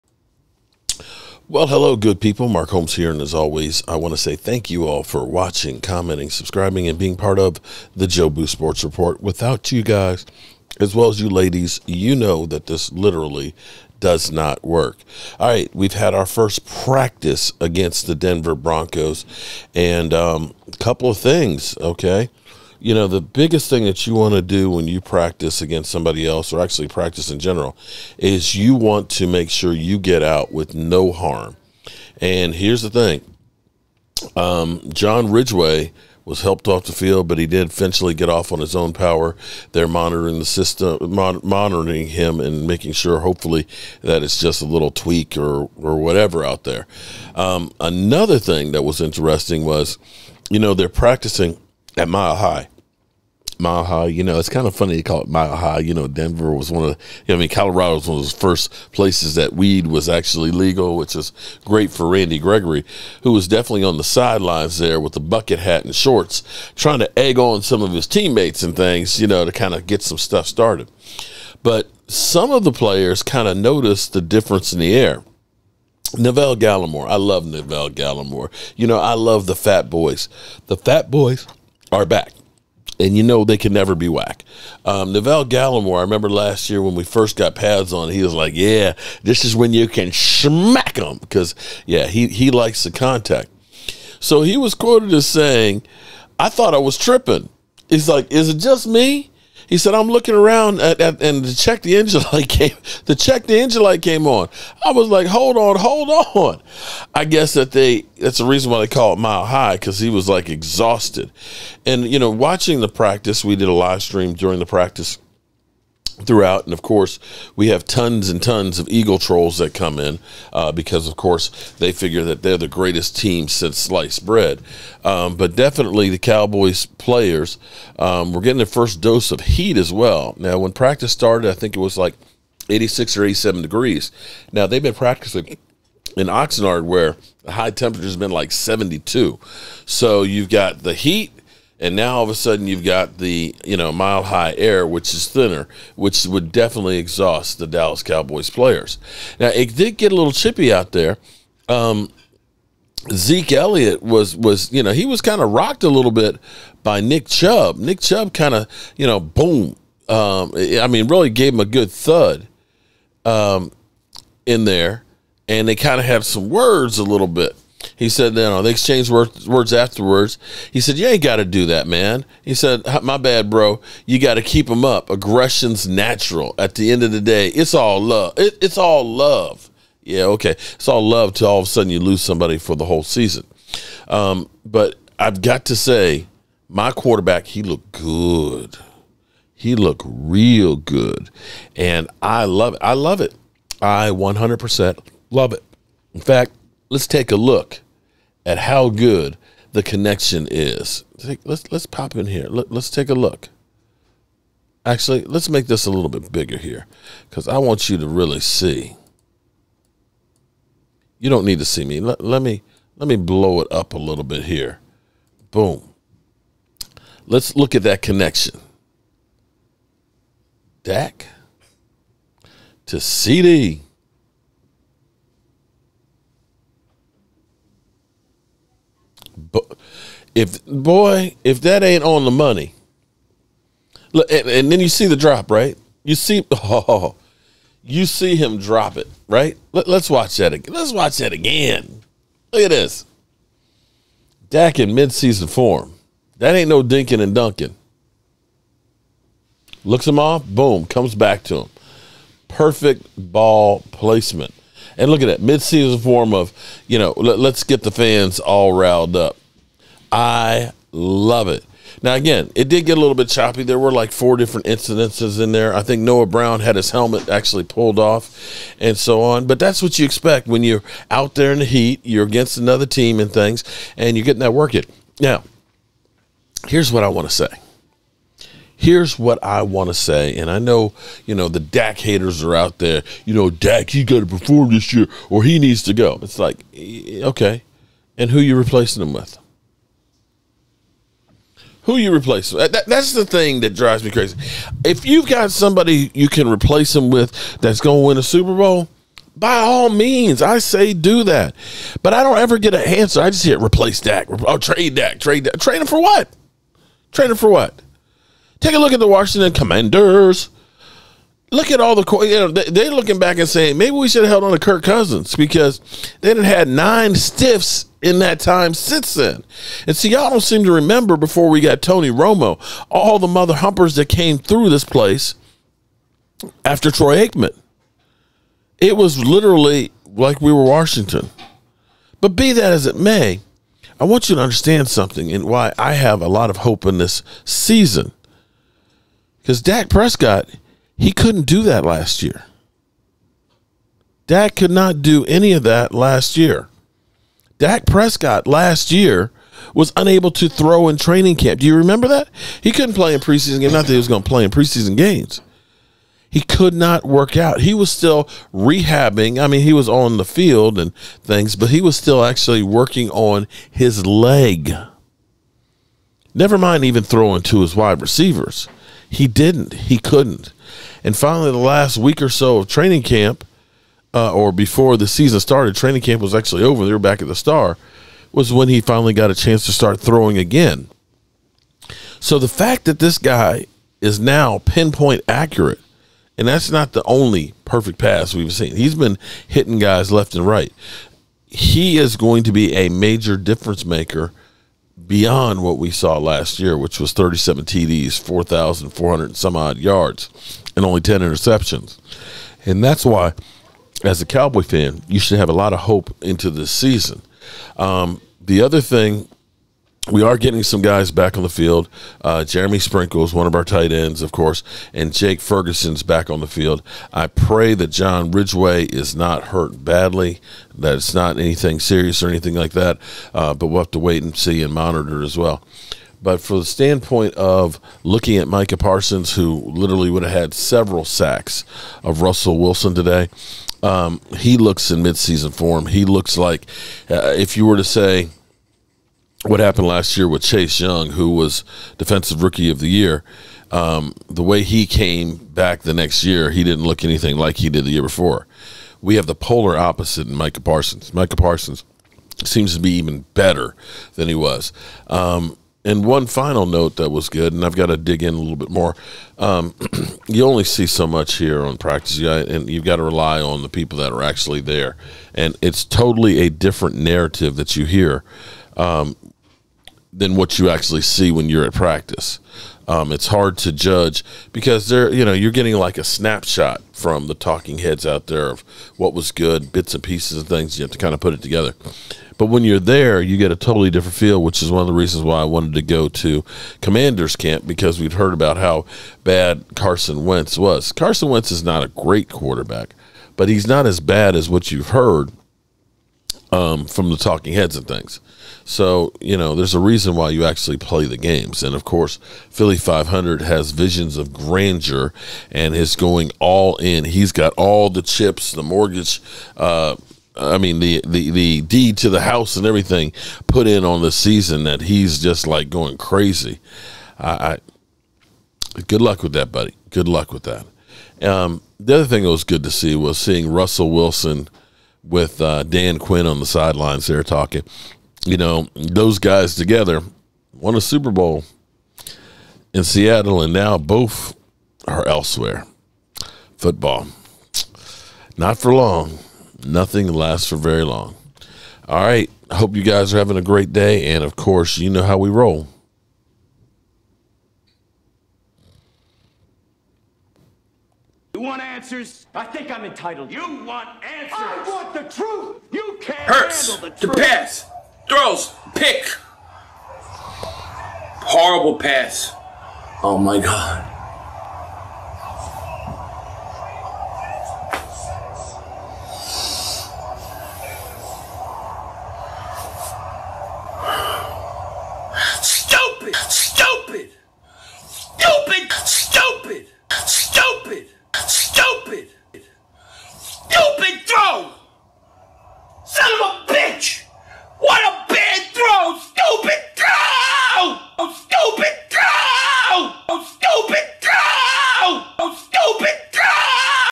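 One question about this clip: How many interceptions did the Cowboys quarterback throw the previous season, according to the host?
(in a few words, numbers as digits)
10.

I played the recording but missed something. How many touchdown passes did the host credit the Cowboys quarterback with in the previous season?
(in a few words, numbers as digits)
37.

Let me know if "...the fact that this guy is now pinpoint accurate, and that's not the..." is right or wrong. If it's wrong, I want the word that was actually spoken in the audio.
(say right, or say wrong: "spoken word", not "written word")
right.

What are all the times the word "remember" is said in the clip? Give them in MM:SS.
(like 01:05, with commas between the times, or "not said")
01:26, 05:20, 05:51.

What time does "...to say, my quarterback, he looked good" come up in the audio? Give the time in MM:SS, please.
03:05.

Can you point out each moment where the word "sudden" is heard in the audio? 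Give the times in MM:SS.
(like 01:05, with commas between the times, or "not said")
02:22, 03:01.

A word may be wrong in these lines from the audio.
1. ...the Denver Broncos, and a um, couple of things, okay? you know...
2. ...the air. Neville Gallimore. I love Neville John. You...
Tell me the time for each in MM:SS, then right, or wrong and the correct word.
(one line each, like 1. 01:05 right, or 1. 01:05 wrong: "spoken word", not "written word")
1. 00:18 right
2. 01:14 wrong: "Gallimore", not "John".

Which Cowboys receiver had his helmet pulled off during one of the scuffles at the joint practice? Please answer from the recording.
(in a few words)
Noah Brown.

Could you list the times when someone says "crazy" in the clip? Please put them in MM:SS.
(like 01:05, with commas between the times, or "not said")
04:54, 08:35.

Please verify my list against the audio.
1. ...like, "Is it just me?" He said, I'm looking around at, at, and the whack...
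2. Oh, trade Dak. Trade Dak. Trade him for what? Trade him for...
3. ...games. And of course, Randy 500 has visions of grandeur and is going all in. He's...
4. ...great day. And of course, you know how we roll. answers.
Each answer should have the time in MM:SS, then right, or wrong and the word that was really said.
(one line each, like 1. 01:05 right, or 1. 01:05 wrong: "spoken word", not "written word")
1. 01:38 wrong: "check", not "whack"
2. 05:04 right
3. 08:21 wrong: "Philly", not "Randy"
4. 09:03 right.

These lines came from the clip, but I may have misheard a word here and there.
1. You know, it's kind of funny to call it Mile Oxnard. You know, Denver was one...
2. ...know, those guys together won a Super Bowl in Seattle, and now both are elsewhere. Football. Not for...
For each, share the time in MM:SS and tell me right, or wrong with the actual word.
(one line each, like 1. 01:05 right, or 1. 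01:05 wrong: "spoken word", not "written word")
1. 00:54 wrong: "High", not "Oxnard"
2. 08:48 right.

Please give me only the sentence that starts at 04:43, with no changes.
You know, Dak, he got to perform this year, or he needs to go.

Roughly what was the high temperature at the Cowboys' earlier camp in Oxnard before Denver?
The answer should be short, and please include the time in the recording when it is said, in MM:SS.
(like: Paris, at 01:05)
72, at 02:18.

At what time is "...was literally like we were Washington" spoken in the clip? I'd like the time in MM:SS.
05:28.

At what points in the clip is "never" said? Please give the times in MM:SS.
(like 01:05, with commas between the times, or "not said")
01:23, 06:06.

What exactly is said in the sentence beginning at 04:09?
Looks him off, boom, comes back to him.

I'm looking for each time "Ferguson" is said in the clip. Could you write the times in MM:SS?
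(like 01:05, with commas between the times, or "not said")
06:55.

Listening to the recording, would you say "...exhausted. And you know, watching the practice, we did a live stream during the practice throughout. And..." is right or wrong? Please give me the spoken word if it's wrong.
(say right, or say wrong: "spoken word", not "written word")
right.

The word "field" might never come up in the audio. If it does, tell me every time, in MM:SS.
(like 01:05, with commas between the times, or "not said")
00:36, 06:00, 06:51, 06:56.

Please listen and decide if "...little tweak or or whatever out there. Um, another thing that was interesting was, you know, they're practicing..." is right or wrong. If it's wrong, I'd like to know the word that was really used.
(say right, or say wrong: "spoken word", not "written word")
right.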